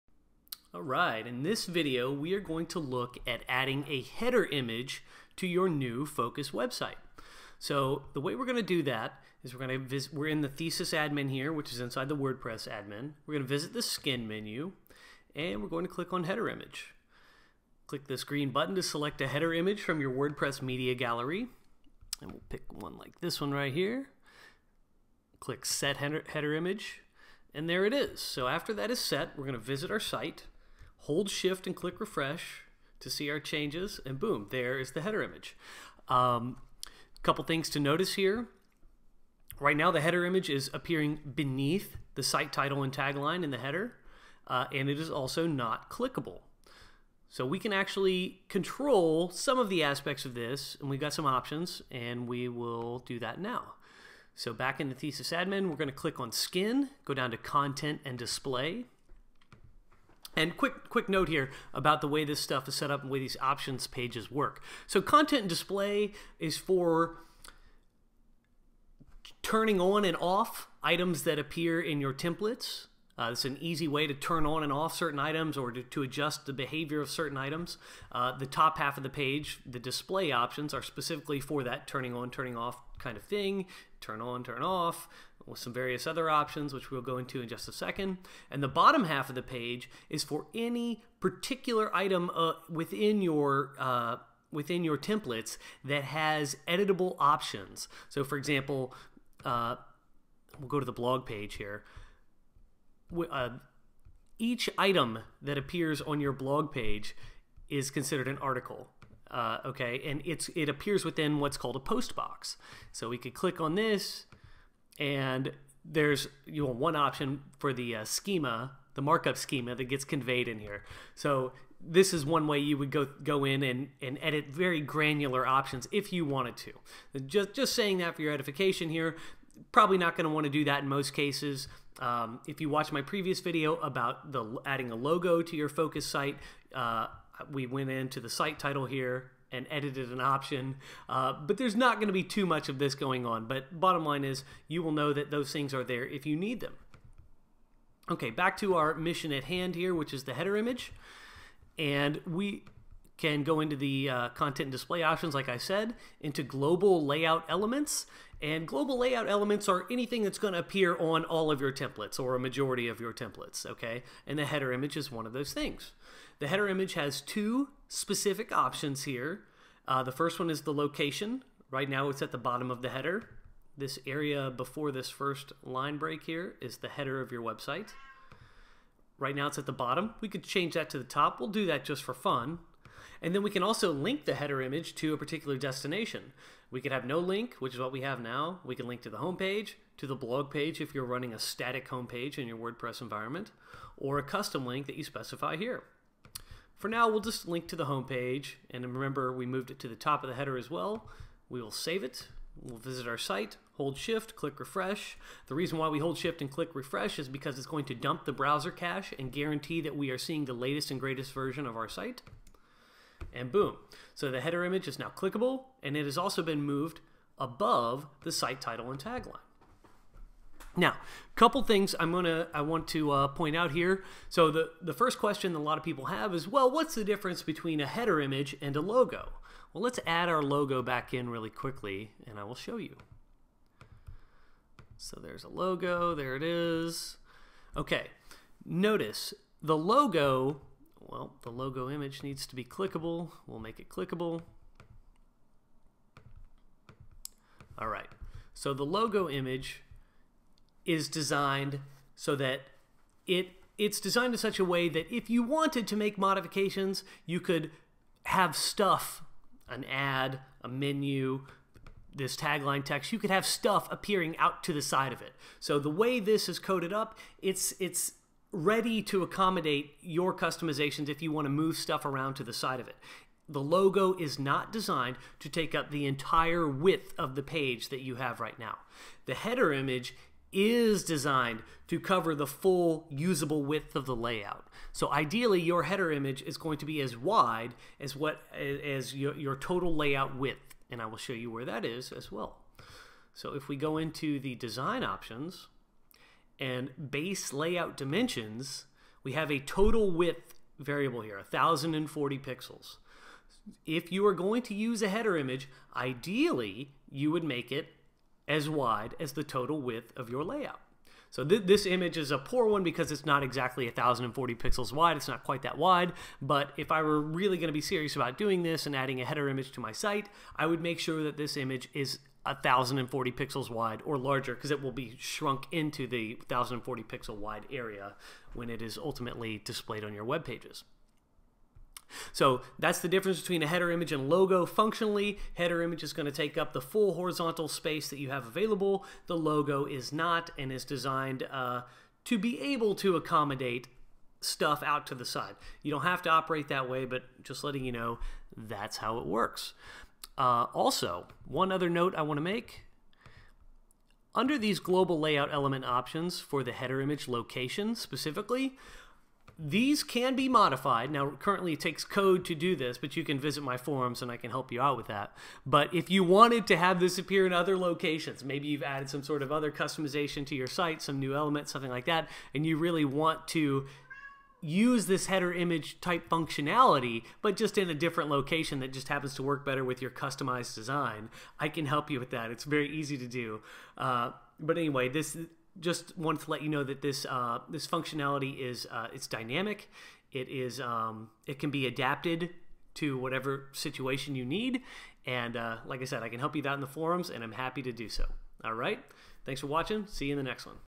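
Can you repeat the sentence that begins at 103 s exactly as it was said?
Uh, each item that appears on your blog page is considered an article.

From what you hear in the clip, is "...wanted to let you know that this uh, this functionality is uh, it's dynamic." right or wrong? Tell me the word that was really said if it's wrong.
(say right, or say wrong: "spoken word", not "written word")
right.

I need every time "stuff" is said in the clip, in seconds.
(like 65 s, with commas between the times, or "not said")
62 s, 258 s, 263 s, 271 s, 344 s.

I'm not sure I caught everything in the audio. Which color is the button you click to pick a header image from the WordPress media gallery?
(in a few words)
Green.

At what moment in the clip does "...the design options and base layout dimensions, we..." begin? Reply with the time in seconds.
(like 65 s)
294 s.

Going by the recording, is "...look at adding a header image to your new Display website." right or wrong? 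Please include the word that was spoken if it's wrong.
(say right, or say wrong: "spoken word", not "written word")
wrong: "Focus", not "Display".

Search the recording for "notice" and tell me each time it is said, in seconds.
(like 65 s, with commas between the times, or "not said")
37 s, 238 s.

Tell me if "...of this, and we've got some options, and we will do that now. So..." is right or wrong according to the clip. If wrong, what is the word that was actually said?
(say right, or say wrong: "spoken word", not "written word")
right.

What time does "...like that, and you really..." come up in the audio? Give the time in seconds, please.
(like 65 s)
371 s.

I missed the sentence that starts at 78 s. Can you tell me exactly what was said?
Uh, the top half of the page, the display options, are specifically for that turning on, turning off kind of thing.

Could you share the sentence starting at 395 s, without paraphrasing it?
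And uh, like I said, I can help you out in the forums, and I'm happy to do so.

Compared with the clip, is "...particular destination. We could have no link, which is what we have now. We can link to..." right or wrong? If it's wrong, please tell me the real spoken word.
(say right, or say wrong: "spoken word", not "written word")
right.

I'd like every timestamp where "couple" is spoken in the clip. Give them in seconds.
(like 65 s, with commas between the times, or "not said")
37 s, 221 s.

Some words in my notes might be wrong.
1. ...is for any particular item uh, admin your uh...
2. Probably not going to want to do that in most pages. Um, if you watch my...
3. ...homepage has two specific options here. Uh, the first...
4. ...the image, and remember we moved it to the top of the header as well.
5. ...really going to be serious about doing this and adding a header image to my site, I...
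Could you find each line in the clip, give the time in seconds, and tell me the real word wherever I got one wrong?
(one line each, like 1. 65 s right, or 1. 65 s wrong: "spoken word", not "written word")
1. 90 s wrong: "within", not "admin"
2. 129 s wrong: "cases", not "pages"
3. 166 s wrong: "image", not "homepage"
4. 197 s wrong: "homepage", not "image"
5. 317 s right.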